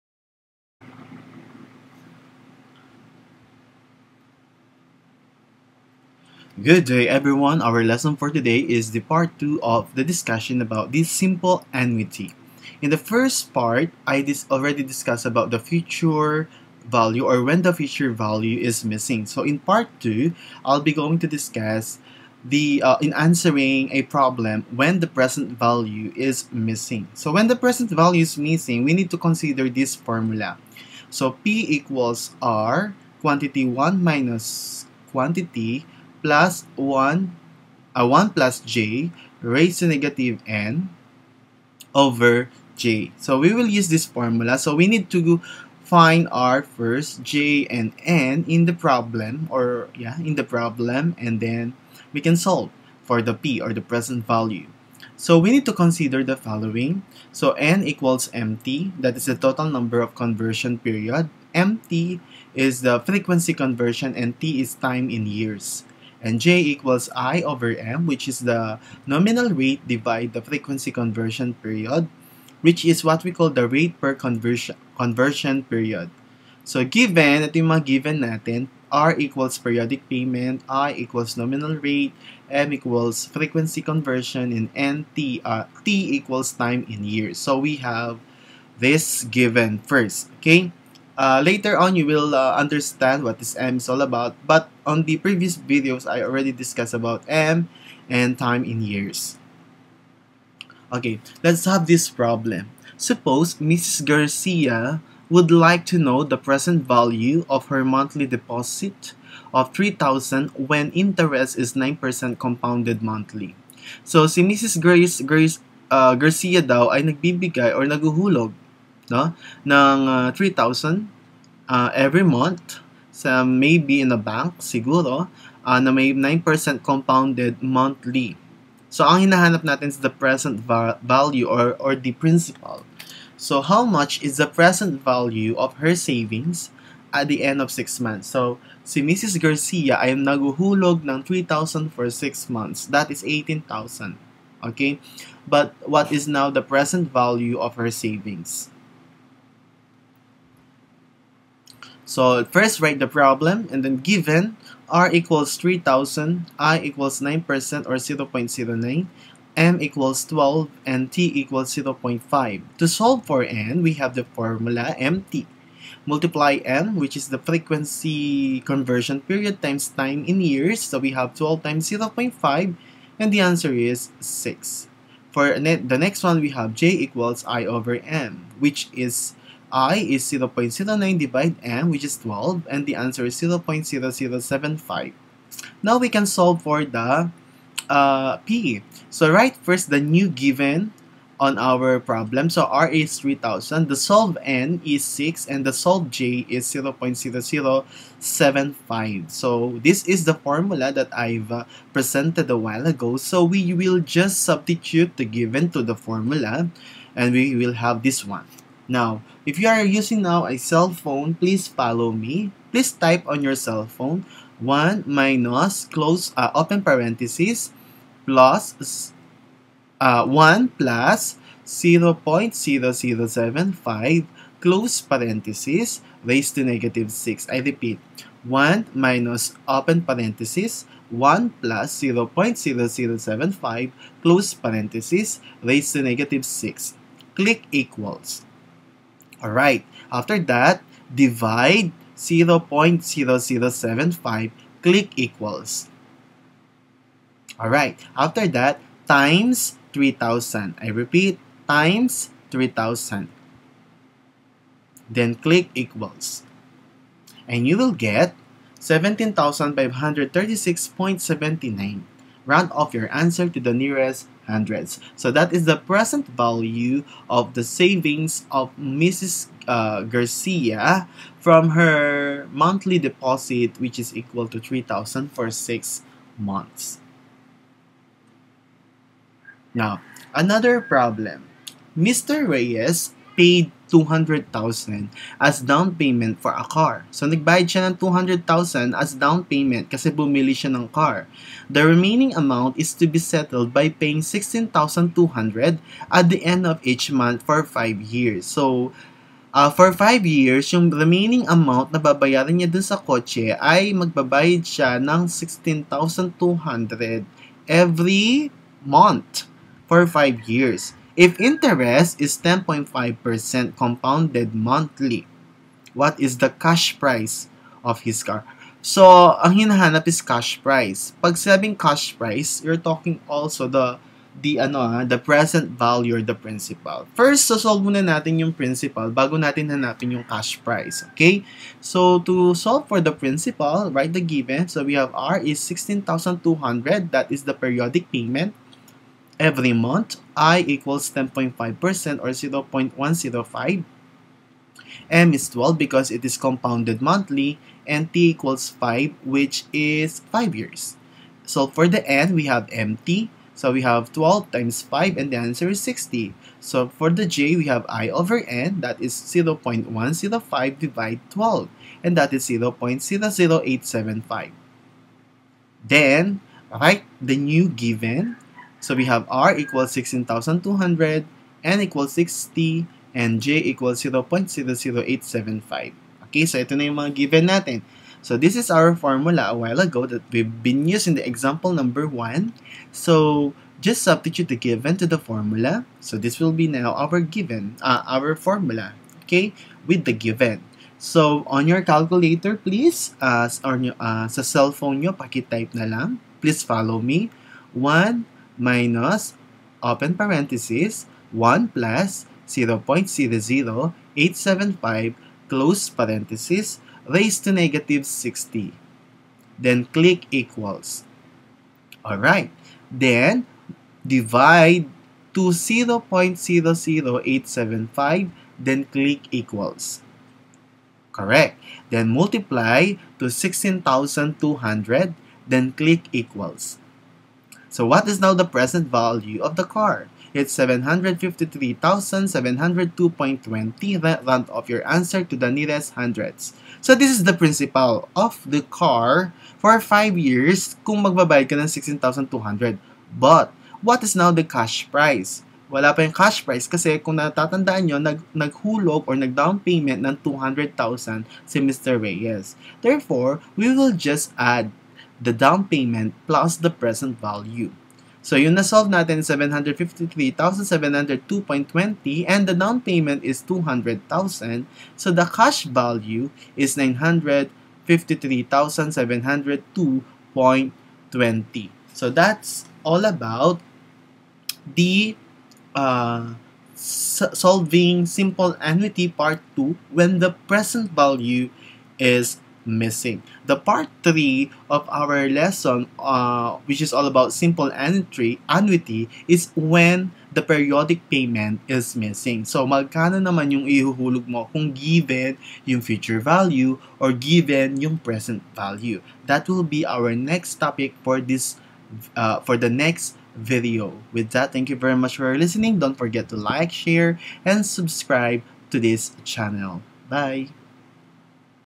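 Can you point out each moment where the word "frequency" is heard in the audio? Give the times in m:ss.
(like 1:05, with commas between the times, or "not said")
1:03, 1:10, 1:23, 2:47.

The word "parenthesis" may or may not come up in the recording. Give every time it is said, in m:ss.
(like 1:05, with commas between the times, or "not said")
3:36, 3:44, 3:50, 3:54, 6:40, 6:45.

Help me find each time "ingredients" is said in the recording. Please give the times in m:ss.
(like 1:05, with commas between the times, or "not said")
not said.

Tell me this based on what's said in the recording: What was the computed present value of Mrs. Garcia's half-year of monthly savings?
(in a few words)
17,536.79.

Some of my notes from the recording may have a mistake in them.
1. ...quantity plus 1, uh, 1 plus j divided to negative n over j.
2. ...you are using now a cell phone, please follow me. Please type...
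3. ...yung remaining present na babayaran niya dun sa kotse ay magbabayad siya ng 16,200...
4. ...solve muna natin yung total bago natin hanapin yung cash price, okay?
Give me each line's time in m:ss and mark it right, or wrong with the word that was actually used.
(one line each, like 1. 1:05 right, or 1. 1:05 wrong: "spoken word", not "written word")
1. 0:35 wrong: "raised", not "divided"
2. 3:29 right
3. 5:00 wrong: "amount", not "present"
4. 5:27 wrong: "principal", not "total".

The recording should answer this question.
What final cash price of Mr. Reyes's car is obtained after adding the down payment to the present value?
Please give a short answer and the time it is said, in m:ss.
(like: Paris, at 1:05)
953,702.20, at 7:46.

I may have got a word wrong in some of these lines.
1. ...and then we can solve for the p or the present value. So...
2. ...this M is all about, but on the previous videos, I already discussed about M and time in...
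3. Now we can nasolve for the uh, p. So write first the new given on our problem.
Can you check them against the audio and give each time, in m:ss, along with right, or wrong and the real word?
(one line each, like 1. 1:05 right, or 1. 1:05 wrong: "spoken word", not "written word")
1. 0:51 right
2. 1:33 right
3. 3:05 wrong: "solve", not "nasolve".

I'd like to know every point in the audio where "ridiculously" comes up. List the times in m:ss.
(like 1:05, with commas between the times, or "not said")
not said.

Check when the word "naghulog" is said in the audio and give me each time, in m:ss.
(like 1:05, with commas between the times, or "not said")
7:28.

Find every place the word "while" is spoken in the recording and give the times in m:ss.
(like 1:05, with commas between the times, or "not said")
3:22, 6:19.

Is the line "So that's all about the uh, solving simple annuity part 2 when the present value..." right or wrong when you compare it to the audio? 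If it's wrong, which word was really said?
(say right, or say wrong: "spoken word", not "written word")
right.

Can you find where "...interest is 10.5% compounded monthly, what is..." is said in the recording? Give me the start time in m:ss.
5:11.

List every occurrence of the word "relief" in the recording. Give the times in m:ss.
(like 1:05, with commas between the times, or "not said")
not said.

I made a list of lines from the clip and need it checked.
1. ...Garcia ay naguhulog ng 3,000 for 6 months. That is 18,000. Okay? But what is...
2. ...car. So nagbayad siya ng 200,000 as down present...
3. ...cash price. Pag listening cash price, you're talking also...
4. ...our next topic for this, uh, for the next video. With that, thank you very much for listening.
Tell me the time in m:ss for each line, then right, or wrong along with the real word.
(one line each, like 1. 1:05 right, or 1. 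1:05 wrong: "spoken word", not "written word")
1. 2:19 right
2. 4:46 wrong: "payment", not "present"
3. 5:20 wrong: "sabing", not "listening"
4. 8:19 right.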